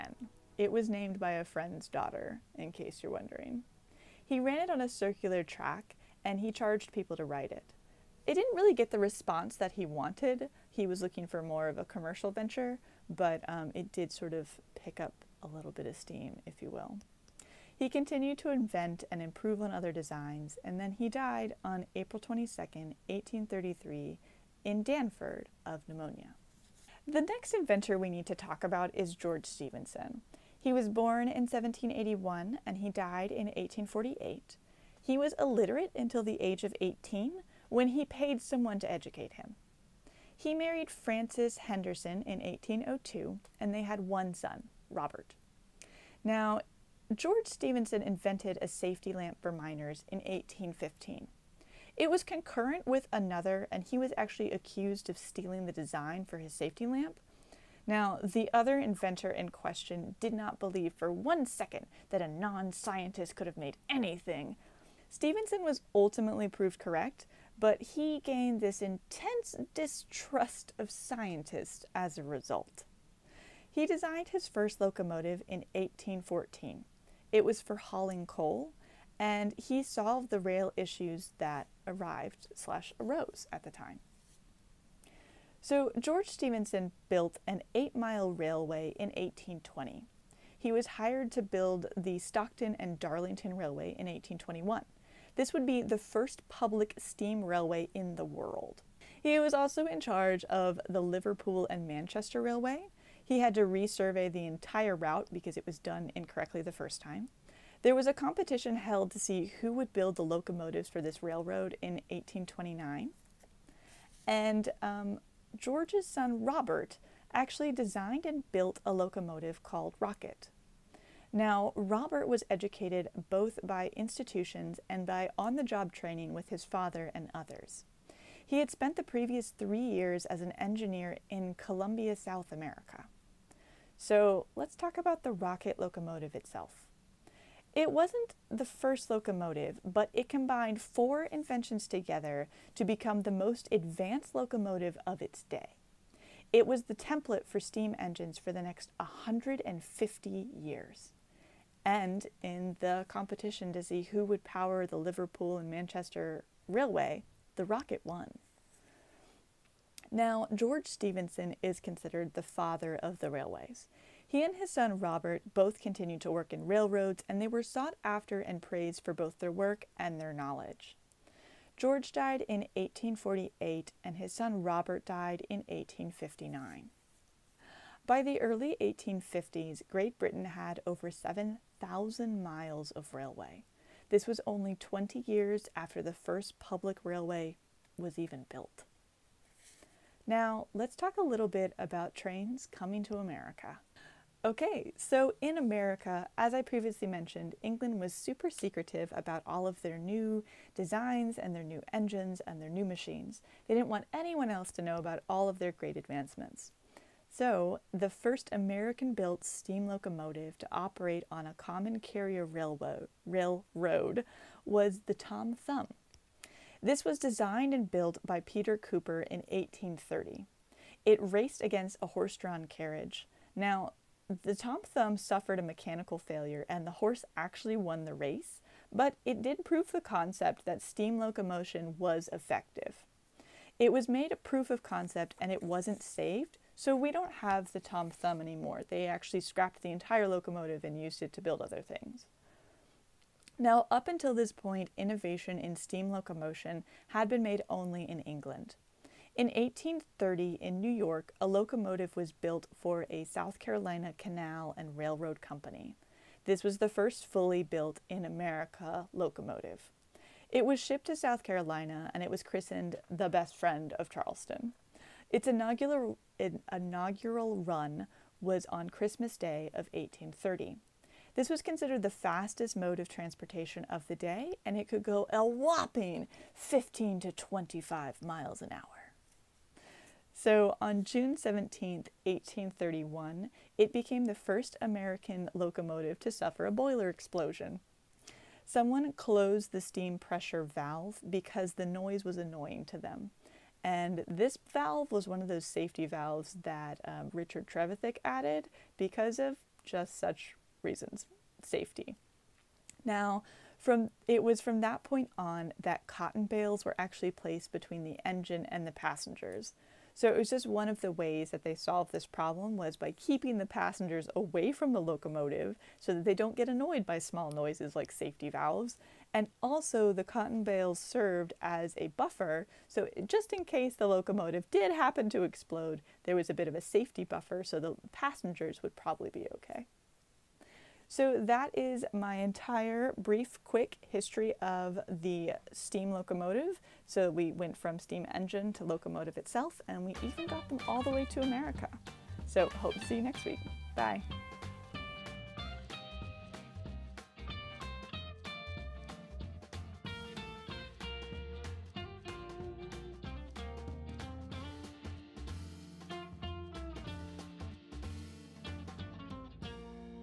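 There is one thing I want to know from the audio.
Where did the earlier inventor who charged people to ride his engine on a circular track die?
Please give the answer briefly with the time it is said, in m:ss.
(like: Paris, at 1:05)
Dartford, at 0:24.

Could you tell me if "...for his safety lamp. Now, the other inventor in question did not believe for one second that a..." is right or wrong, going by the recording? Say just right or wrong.
right.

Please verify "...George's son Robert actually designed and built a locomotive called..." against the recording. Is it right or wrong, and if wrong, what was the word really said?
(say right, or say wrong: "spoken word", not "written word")
right.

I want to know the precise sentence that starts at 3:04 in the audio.
This was only 20 years after the first public railway was even built.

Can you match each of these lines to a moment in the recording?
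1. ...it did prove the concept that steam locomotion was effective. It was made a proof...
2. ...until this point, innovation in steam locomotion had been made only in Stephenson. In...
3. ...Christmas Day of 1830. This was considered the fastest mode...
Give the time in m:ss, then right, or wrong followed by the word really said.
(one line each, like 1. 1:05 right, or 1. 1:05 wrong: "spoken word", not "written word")
1. 3:49 right
2. 4:04 wrong: "England", not "Stephenson"
3. 4:28 right.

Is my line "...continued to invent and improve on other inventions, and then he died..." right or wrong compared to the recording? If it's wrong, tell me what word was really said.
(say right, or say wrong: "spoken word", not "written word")
wrong: "designs", not "inventions".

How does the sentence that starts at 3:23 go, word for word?
They didn't want anyone else to know about all of their great advancements.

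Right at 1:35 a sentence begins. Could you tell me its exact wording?
This would be the first public steam railway in the world.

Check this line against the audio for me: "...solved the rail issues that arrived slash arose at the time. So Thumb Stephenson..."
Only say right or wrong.
wrong.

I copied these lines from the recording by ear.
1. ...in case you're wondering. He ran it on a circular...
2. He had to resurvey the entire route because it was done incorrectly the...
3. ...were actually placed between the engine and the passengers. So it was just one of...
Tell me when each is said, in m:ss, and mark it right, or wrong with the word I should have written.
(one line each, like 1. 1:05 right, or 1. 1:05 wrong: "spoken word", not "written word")
1. 0:02 right
2. 1:43 right
3. 5:06 right.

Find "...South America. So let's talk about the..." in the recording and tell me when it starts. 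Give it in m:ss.
2:12.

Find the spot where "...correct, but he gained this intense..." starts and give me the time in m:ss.
1:06.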